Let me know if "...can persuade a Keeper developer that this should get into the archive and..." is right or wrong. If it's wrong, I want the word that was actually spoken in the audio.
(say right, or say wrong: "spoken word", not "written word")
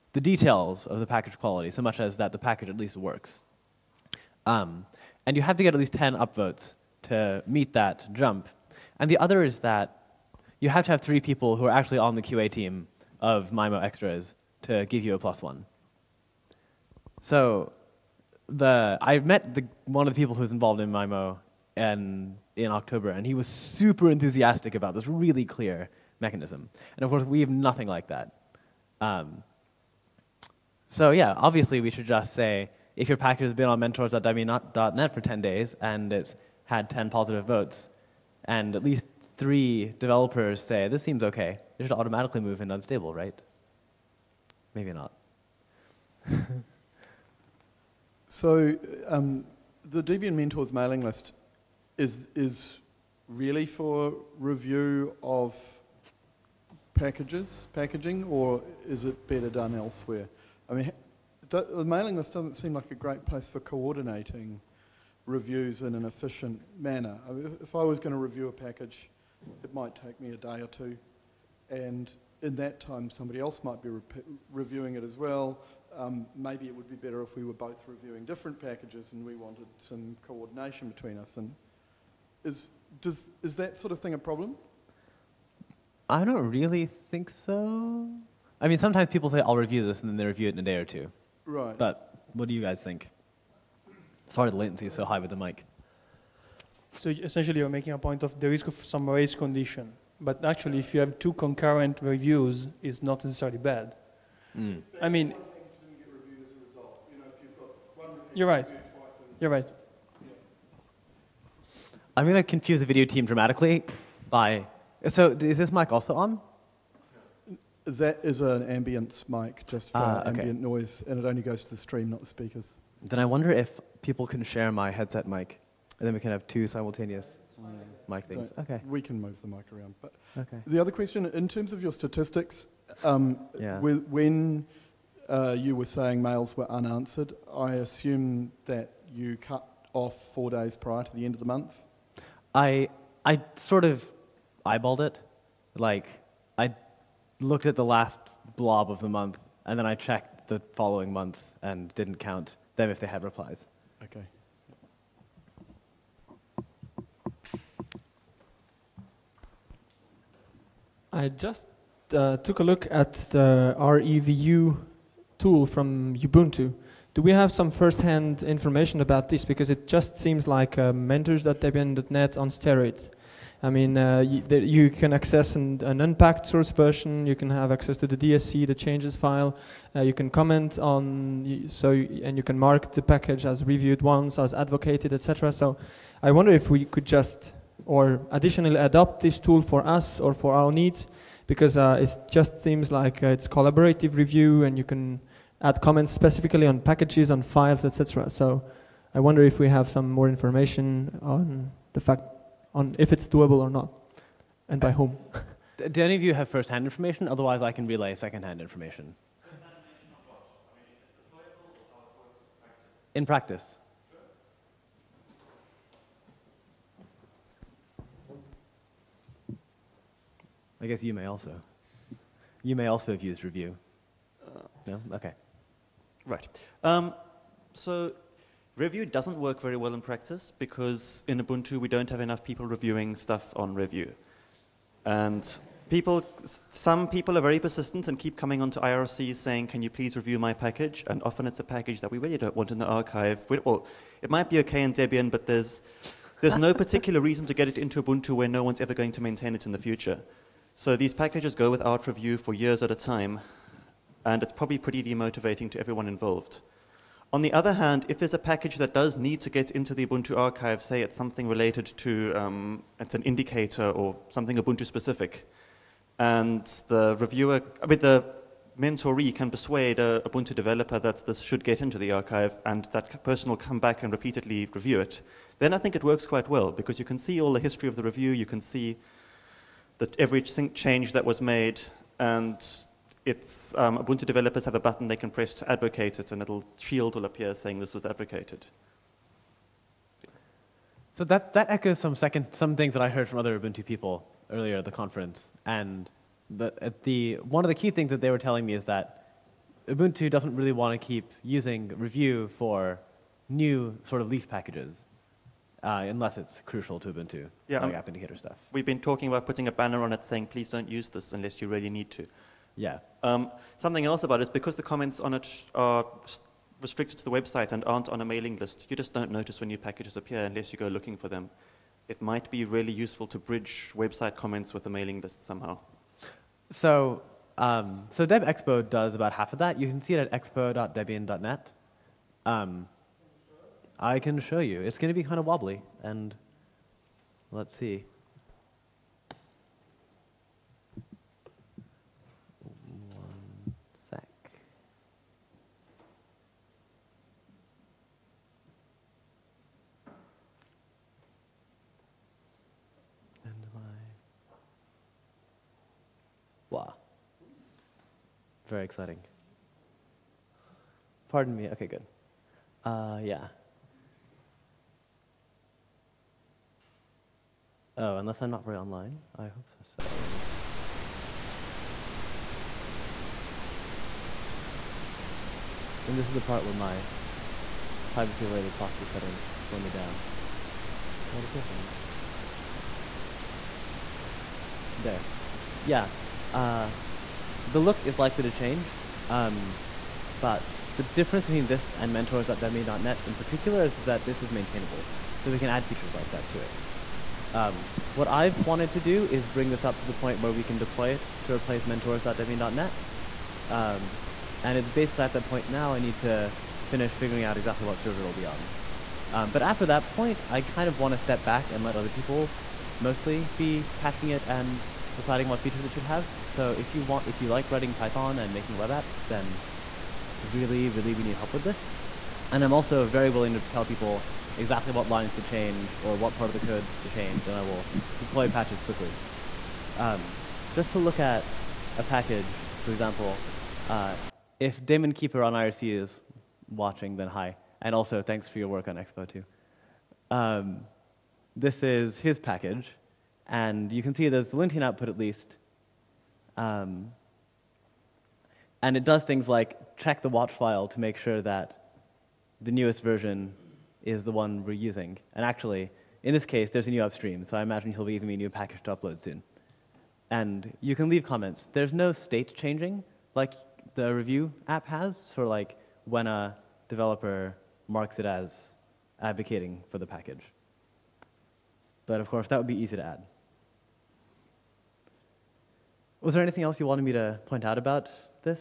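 wrong: "Ubuntu", not "Keeper".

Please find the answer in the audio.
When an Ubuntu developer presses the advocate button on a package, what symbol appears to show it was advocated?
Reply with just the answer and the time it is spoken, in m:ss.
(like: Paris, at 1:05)
a shield, at 4:46.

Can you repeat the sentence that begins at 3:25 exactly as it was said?
Do any of you have first-hand information?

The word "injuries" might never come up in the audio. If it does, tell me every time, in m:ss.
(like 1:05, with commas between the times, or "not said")
not said.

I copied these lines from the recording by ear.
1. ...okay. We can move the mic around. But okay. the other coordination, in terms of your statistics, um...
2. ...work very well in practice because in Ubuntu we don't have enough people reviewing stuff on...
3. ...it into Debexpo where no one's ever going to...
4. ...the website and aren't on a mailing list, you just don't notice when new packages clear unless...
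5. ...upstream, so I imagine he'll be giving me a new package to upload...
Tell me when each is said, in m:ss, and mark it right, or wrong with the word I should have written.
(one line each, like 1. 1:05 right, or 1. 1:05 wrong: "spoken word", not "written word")
1. 2:08 wrong: "question", not "coordination"
2. 3:49 right
3. 4:07 wrong: "Ubuntu", not "Debexpo"
4. 5:17 wrong: "appear", not "clear"
5. 7:37 right.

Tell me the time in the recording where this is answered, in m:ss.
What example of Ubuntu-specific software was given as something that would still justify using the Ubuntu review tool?
5:07.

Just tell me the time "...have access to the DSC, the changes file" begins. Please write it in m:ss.
2:57.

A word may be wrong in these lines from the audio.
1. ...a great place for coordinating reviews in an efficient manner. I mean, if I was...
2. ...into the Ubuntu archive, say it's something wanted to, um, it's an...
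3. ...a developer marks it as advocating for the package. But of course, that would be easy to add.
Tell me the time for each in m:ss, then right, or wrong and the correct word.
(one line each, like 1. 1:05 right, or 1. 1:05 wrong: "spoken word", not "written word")
1. 1:02 right
2. 4:19 wrong: "related", not "wanted"
3. 7:46 right.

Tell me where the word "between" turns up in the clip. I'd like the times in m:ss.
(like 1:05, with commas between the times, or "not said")
1:20, 6:31.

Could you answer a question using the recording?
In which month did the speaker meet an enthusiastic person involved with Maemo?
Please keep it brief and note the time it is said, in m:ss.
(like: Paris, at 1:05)
October, at 0:22.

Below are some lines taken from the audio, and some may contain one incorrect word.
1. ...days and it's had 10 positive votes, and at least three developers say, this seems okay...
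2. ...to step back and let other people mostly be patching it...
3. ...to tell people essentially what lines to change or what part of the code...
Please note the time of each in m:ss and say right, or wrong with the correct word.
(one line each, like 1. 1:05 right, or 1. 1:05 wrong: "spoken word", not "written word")
1. 0:35 right
2. 6:51 right
3. 7:03 wrong: "exactly", not "essentially".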